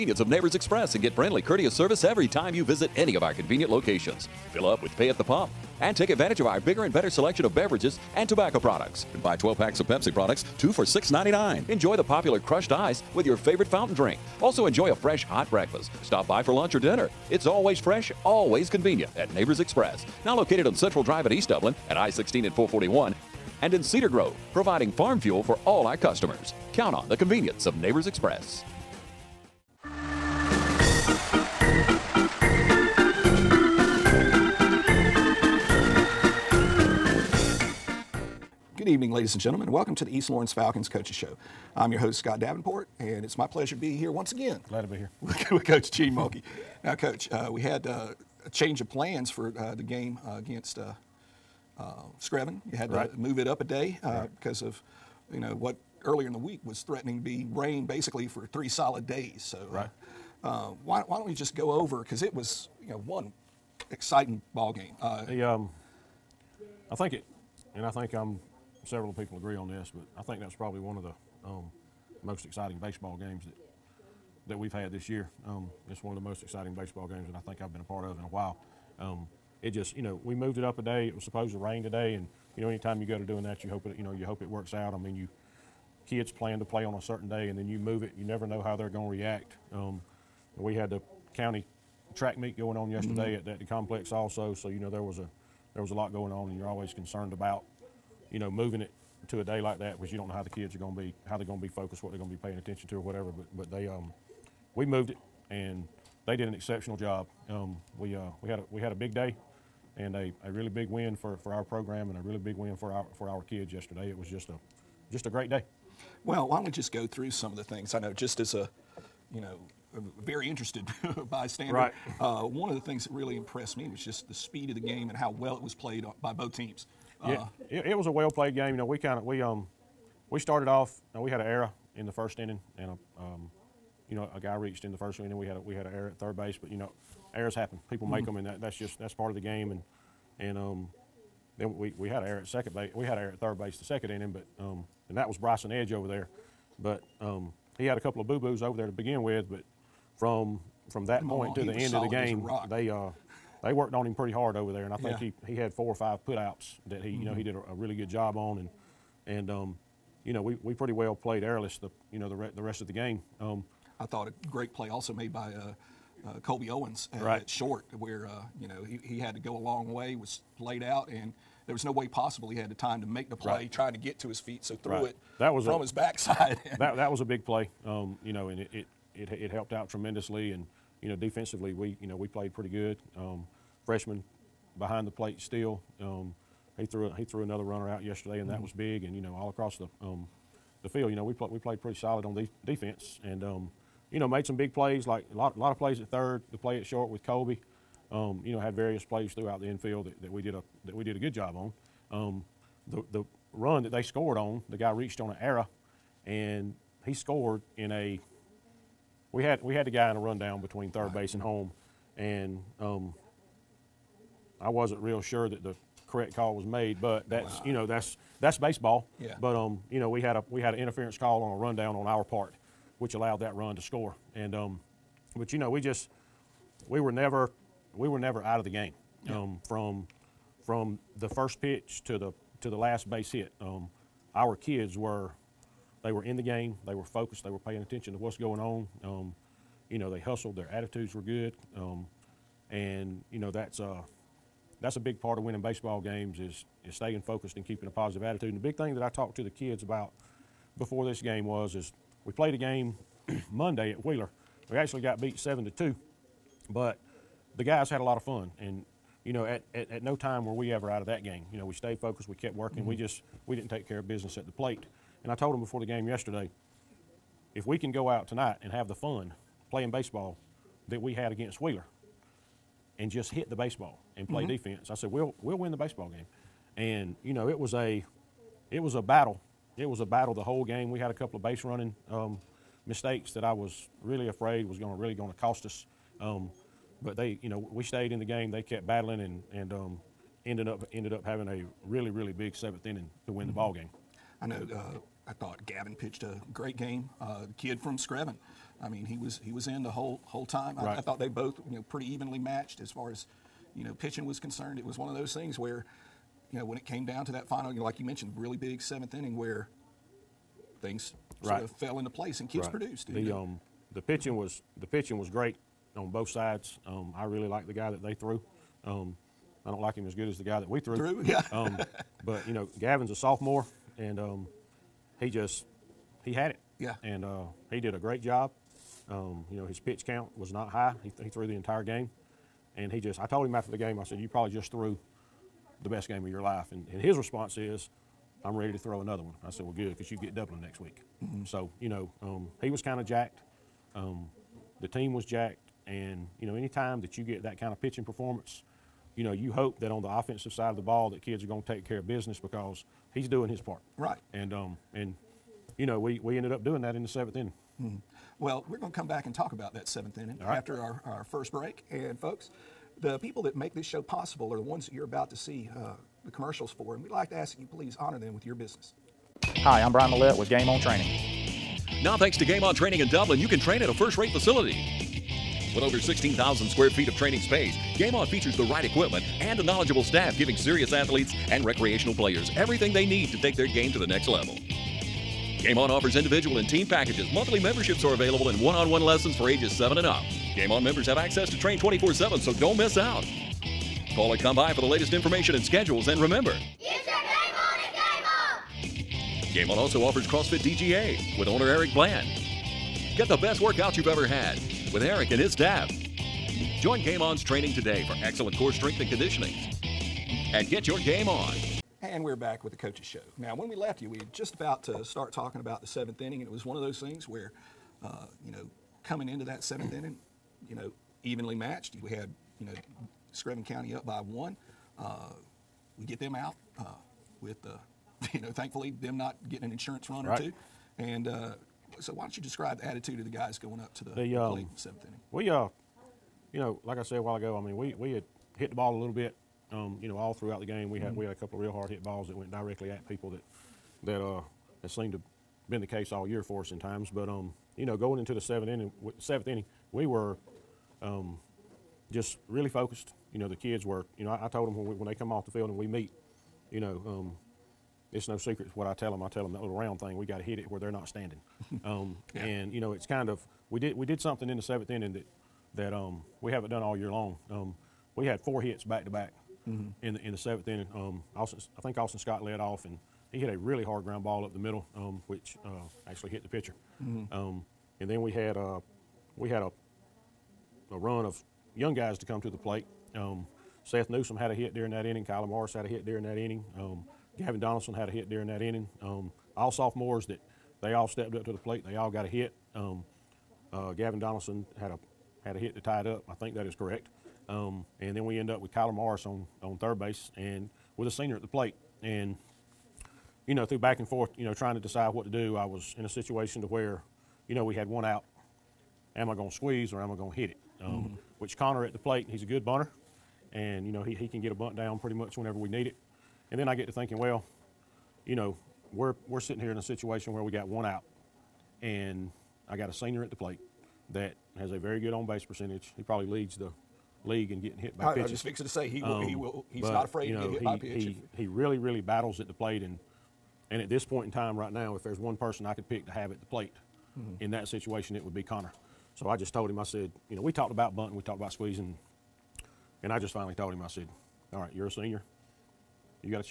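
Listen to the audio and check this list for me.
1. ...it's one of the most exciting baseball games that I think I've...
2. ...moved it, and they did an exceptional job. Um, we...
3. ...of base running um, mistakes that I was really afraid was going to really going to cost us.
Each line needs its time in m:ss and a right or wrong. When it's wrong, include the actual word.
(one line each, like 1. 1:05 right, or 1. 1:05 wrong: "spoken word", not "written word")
1. 1:15 right
2. 1:44 right
3. 4:41 right.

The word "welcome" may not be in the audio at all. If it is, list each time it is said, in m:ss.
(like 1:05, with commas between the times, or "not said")
0:39.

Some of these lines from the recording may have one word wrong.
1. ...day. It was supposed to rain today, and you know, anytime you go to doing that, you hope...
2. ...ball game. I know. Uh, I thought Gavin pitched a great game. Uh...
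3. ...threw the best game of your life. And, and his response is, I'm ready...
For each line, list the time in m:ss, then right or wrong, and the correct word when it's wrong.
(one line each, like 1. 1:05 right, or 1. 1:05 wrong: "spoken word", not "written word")
1. 1:20 right
2. 4:53 right
3. 5:34 right.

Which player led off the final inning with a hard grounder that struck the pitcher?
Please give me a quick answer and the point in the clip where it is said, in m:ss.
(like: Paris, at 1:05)
Austin Scott, at 7:51.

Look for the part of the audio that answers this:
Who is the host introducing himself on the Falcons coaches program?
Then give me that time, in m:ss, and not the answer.
0:42.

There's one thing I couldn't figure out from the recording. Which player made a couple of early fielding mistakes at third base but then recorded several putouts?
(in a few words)
Bryson Edge.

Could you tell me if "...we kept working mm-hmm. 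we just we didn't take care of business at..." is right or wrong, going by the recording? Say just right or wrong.
right.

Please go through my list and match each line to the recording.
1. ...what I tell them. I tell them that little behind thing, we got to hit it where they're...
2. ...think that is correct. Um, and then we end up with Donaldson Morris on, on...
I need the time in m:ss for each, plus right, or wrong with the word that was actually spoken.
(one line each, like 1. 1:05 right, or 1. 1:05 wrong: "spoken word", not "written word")
1. 7:38 wrong: "round", not "behind"
2. 8:16 wrong: "Kyler", not "Donaldson".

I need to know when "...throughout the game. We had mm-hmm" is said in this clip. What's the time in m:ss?
7:20.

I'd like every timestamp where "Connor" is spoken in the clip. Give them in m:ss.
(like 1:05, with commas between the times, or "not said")
8:31, 8:58.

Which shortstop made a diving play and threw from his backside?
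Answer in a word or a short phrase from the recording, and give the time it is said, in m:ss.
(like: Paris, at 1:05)
Colby Owens, at 2:46.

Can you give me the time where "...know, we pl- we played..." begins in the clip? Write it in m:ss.
3:11.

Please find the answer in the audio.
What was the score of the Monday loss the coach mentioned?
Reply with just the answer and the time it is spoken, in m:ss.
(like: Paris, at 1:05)
7 to 2, at 4:15.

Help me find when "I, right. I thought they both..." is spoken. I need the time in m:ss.
5:00.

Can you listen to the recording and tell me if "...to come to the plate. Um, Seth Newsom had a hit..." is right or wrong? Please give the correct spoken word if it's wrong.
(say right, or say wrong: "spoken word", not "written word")
right.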